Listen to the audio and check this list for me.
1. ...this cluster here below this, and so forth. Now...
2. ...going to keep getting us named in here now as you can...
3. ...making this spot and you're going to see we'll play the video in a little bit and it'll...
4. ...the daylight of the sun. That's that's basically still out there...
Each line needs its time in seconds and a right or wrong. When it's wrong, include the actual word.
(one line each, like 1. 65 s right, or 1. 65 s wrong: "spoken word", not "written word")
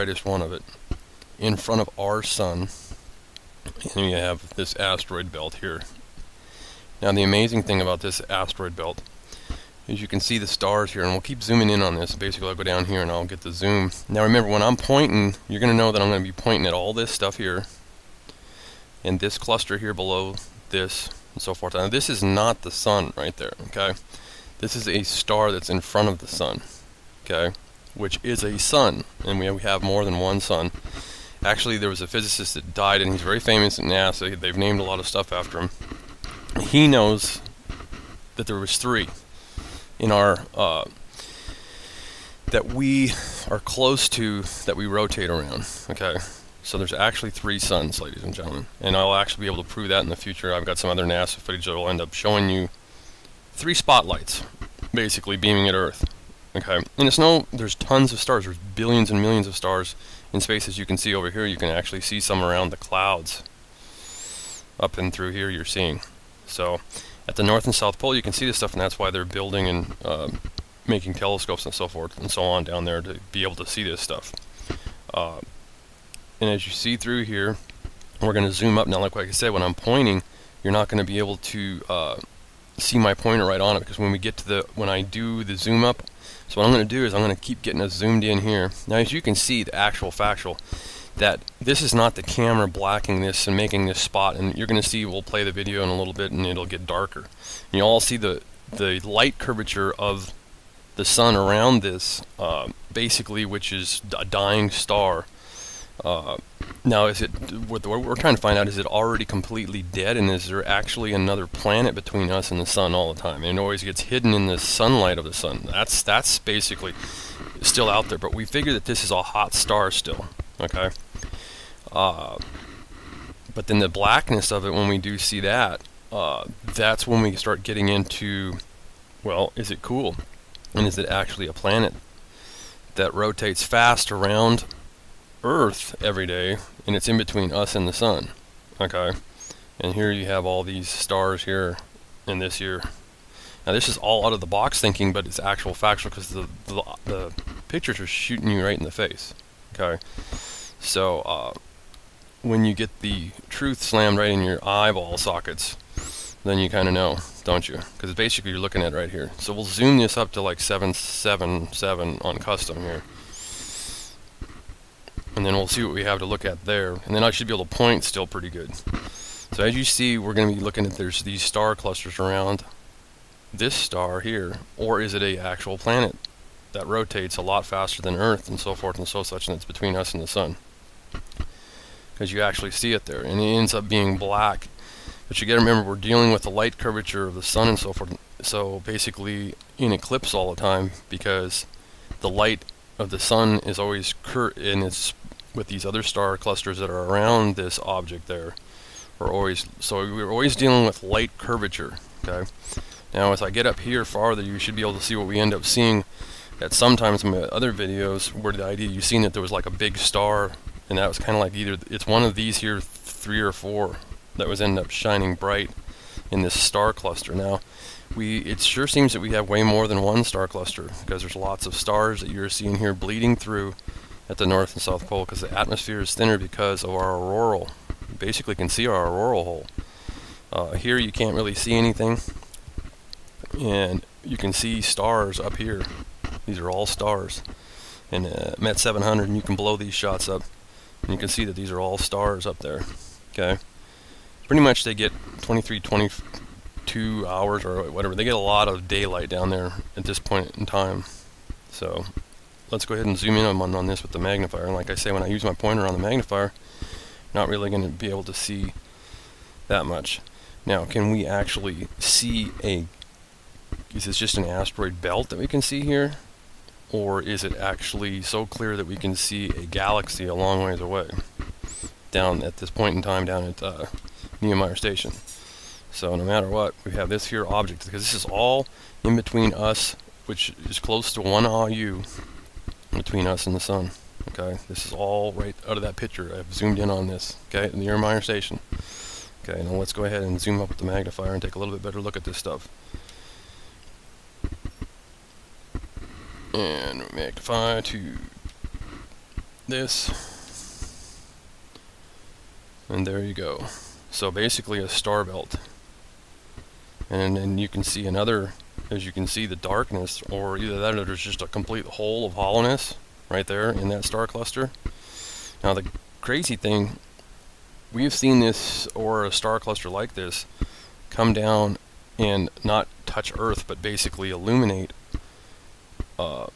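1. 19 s right
2. 87 s wrong: "zoomed", not "named"
3. 93 s right
4. 114 s wrong: "sunlight", not "daylight".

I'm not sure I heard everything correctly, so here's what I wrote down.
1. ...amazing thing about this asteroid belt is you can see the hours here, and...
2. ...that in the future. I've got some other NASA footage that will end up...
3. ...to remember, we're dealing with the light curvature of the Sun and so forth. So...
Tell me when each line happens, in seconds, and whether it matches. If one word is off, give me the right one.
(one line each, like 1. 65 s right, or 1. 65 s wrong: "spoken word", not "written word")
1. 7 s wrong: "stars", not "hours"
2. 49 s right
3. 185 s right.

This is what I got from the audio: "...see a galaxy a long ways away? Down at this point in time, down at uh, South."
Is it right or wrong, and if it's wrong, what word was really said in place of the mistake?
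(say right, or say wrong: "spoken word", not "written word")
wrong: "Station", not "South".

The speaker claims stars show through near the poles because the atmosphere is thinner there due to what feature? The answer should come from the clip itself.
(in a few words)
auroral hole.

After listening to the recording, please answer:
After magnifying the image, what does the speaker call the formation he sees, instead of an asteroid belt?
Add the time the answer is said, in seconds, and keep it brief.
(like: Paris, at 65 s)
star belt, at 304 s.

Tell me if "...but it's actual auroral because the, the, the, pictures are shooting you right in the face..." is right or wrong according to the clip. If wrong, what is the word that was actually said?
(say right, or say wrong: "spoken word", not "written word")
wrong: "factual", not "auroral".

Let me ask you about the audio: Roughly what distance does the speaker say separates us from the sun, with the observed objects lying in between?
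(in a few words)
1 AU.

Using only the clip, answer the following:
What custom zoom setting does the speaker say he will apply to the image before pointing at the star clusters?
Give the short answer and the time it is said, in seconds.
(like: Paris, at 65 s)
777, at 160 s.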